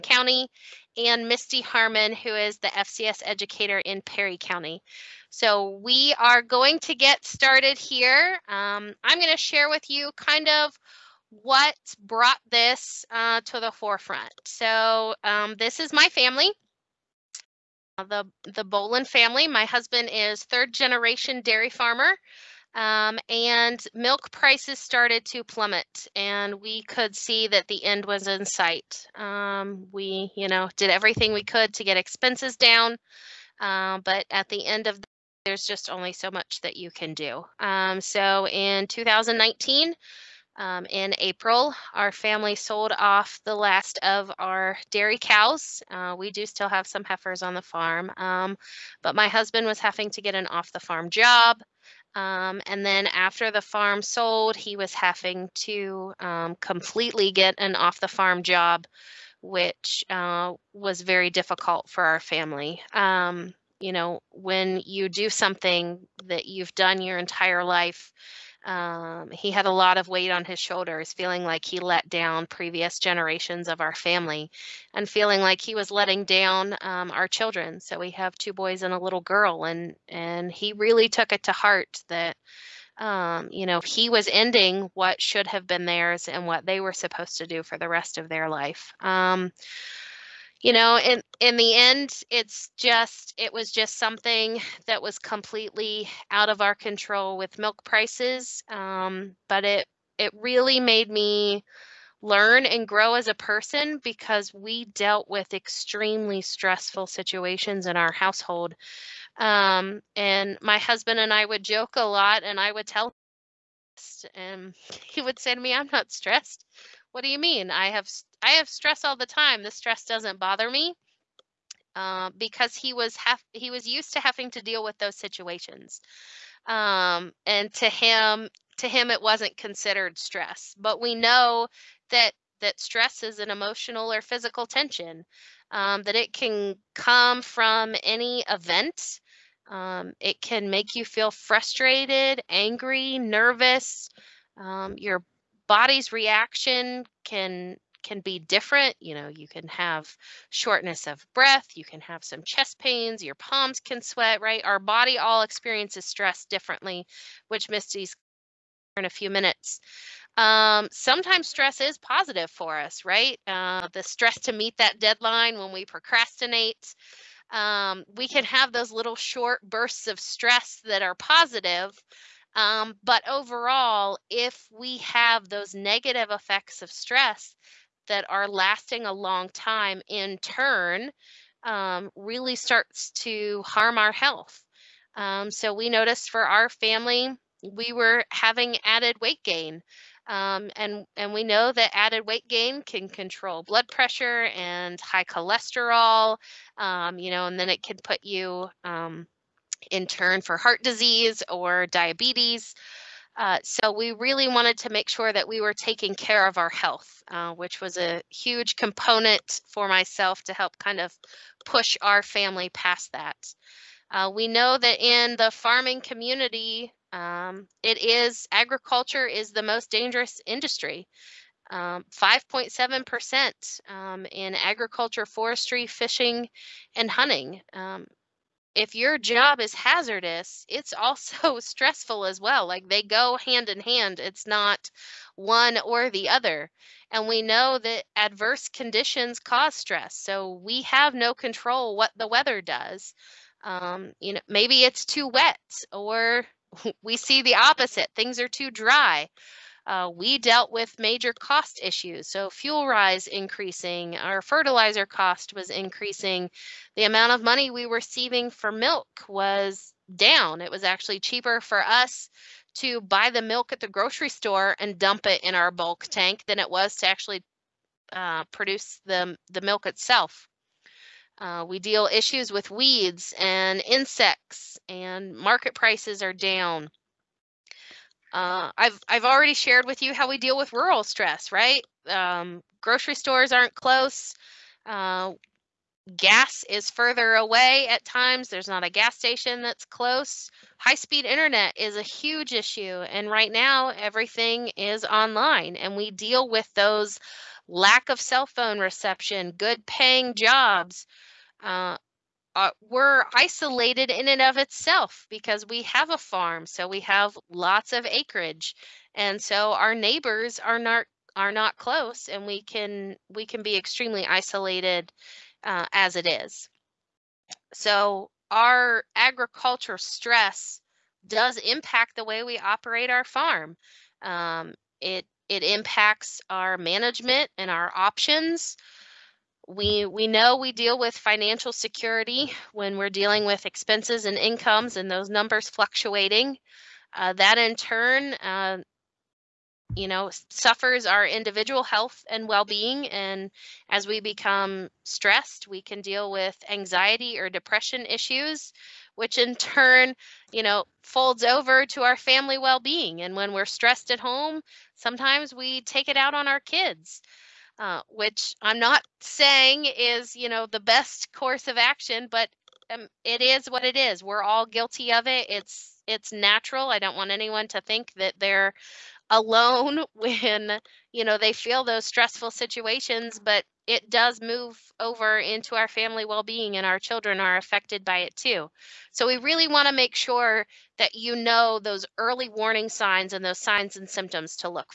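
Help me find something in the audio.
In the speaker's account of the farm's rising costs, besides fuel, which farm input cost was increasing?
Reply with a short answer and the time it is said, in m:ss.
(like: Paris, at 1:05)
Fertilizer, at 4:14.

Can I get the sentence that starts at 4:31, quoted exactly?
Uh, we deal issues with weeds and insects and market prices are down.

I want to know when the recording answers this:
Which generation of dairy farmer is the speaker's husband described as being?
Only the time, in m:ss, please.
0:20.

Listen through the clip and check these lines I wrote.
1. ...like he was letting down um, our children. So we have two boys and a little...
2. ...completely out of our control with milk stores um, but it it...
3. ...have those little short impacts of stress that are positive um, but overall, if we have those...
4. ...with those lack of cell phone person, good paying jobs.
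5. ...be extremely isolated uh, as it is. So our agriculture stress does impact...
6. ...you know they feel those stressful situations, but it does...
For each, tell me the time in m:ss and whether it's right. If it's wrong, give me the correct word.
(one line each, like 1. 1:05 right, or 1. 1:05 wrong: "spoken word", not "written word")
1. 1:15 right
2. 1:35 wrong: "prices", not "stores"
3. 2:48 wrong: "bursts", not "impacts"
4. 4:56 wrong: "reception", not "person"
5. 5:13 right
6. 6:11 right.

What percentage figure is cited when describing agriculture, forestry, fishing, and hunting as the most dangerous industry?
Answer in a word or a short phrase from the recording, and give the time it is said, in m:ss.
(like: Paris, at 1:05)
5.7%, at 3:41.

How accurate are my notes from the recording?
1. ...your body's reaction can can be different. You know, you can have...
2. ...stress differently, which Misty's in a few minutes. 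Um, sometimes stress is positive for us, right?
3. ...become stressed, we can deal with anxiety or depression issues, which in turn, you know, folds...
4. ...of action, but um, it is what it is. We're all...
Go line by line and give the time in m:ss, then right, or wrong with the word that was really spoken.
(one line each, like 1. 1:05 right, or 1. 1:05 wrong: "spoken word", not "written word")
1. 2:24 right
2. 2:36 right
3. 5:44 right
4. 6:01 right.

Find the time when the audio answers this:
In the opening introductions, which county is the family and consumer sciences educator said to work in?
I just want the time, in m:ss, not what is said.
0:04.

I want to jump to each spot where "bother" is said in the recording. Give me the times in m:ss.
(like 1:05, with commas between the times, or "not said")
2:00.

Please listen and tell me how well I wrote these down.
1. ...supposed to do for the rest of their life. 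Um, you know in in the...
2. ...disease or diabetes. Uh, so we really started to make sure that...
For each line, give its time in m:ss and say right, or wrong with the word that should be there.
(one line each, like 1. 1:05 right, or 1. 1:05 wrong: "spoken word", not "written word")
1. 1:26 right
2. 3:20 wrong: "wanted", not "started".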